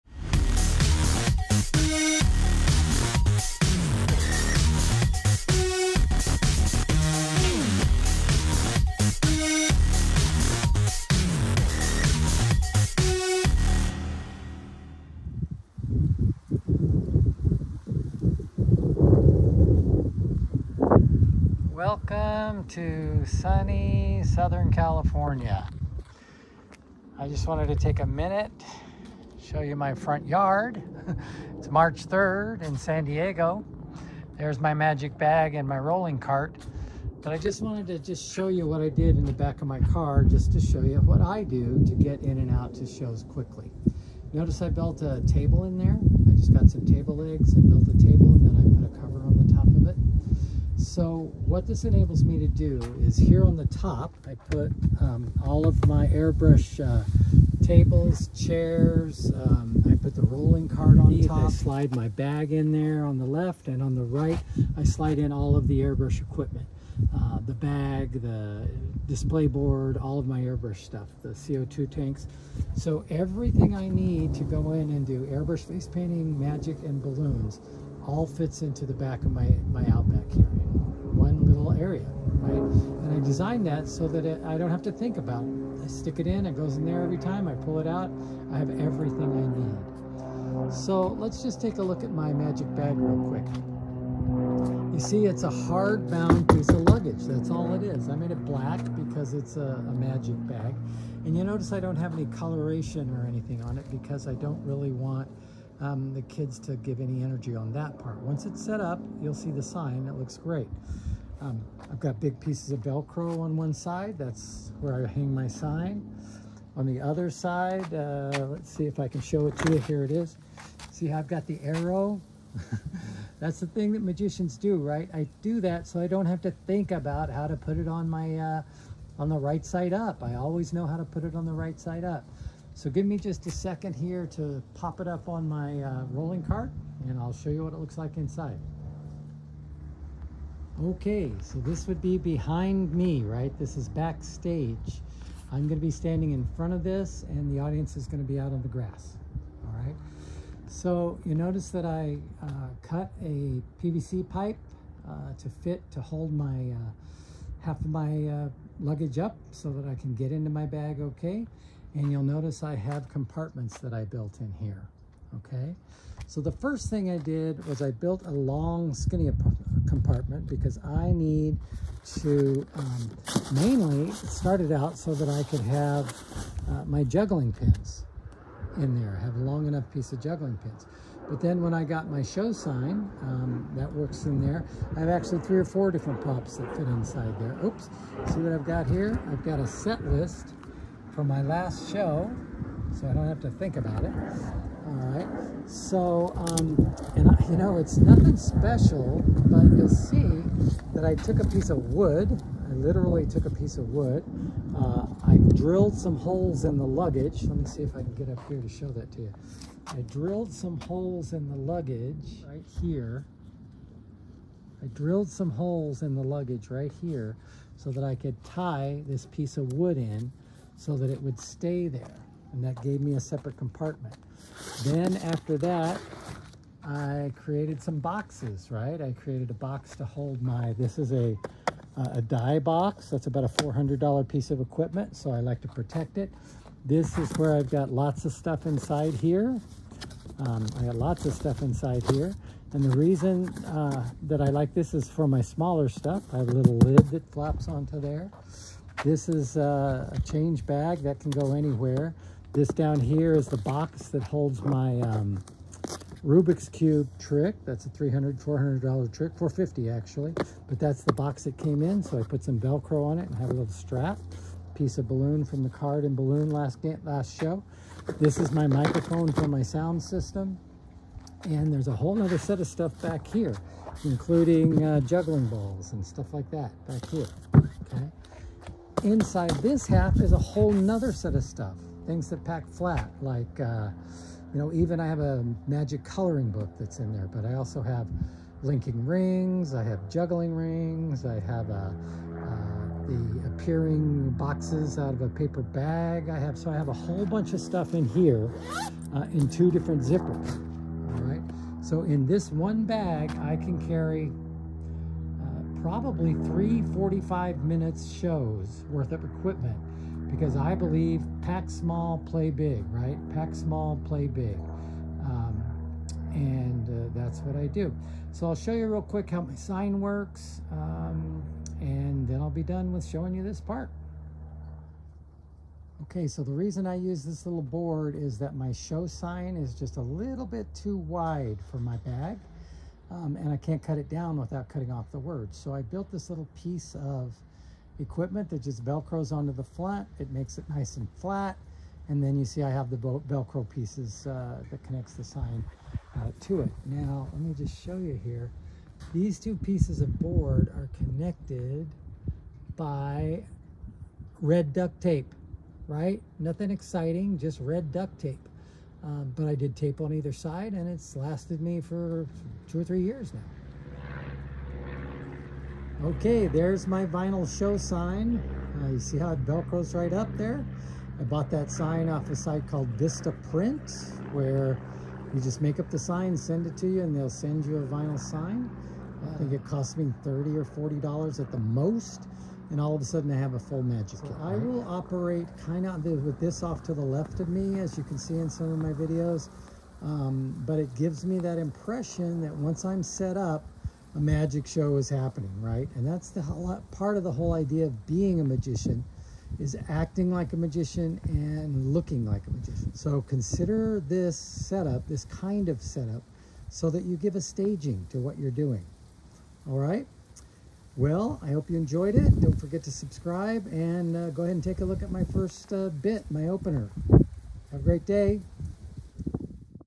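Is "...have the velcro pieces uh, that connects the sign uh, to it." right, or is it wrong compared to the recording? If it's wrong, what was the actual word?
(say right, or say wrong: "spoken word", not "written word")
right.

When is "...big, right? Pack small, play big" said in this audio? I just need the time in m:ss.
5:12.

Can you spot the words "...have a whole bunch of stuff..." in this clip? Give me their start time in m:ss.
4:56.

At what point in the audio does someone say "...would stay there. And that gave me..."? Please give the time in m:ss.
3:41.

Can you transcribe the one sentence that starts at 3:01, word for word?
But then when I got my show sign, um, that works in there.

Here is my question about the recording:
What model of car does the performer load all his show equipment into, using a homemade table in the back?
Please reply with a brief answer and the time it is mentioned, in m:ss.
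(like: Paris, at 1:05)
Outback, at 1:19.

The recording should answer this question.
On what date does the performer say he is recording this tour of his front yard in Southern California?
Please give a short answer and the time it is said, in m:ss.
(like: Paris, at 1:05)
March 3rd, at 0:31.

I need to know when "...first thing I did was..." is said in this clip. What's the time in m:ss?
2:46.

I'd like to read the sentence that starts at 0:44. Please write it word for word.
Notice I built a table in there.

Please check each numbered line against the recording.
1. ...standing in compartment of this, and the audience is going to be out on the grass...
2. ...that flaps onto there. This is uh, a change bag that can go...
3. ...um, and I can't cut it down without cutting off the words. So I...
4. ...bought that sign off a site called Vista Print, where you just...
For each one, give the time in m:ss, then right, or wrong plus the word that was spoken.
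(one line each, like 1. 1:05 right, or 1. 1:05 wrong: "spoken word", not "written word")
1. 2:25 wrong: "front", not "compartment"
2. 4:07 right
3. 5:33 right
4. 6:11 right.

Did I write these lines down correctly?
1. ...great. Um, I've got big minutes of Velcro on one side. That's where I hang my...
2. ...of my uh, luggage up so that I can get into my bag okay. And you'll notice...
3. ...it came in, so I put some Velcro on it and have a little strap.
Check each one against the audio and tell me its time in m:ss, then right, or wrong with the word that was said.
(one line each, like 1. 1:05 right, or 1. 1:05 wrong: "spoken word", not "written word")
1. 1:50 wrong: "pieces", not "minutes"
2. 2:37 right
3. 4:21 right.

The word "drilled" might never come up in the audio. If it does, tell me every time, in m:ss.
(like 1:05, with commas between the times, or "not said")
3:25, 3:30, 3:34.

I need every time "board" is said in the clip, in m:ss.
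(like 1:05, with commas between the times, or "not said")
1:09, 5:27, 5:50.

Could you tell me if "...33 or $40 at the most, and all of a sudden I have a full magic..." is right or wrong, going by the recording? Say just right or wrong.
wrong.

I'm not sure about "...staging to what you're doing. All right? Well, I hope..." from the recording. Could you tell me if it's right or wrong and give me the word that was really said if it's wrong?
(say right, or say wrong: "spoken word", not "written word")
right.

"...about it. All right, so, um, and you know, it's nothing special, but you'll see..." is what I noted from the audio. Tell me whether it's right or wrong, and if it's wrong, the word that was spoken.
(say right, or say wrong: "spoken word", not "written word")
right.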